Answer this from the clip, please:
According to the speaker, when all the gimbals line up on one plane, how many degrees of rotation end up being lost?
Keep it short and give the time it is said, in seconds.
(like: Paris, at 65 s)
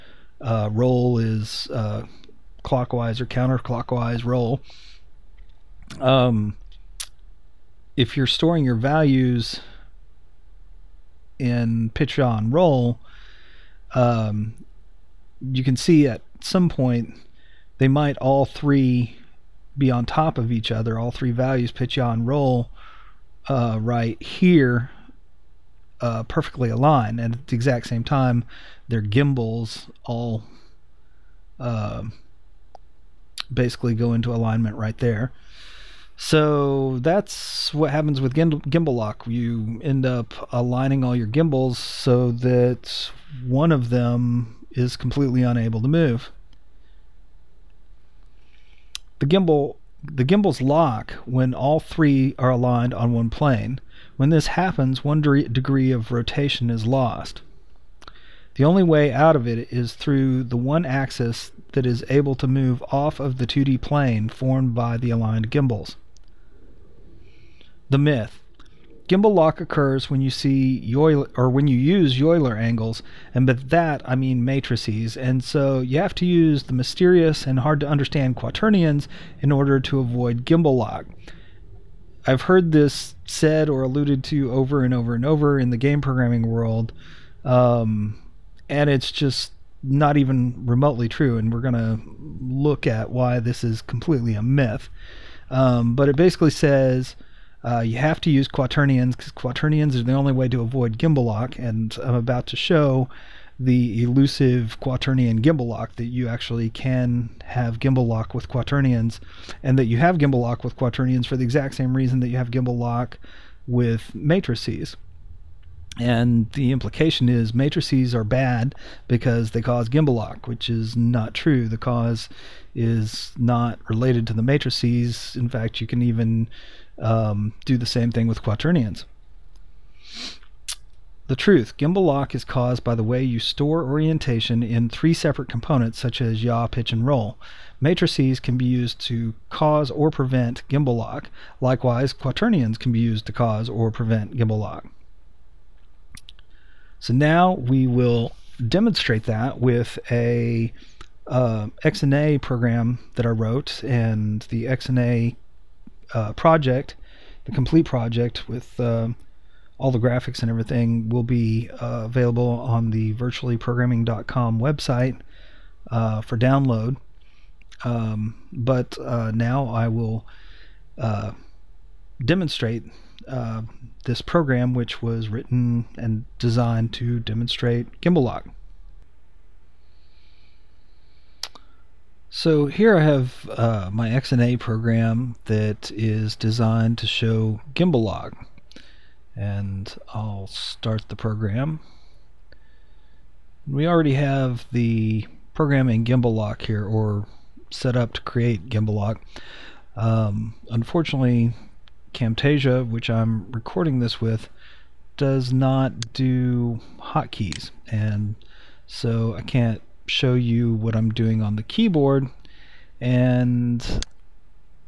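1, at 55 s.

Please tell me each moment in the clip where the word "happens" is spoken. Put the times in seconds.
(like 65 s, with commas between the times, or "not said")
37 s, 54 s.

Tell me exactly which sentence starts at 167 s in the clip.
Um, but uh, now I will demonstrate this program, which was written and designed to demonstrate gimbal lock.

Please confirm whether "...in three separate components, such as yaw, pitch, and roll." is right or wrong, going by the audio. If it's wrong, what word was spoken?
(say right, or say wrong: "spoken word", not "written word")
right.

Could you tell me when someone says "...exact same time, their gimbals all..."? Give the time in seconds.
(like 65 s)
27 s.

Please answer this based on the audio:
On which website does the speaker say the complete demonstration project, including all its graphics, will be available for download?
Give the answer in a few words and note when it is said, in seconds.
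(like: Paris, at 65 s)
virtuallyprogramming.com, at 163 s.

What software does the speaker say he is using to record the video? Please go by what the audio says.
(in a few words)
Camtasia.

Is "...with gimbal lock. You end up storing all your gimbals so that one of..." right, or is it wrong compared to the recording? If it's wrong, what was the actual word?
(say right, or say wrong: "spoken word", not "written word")
wrong: "aligning", not "storing".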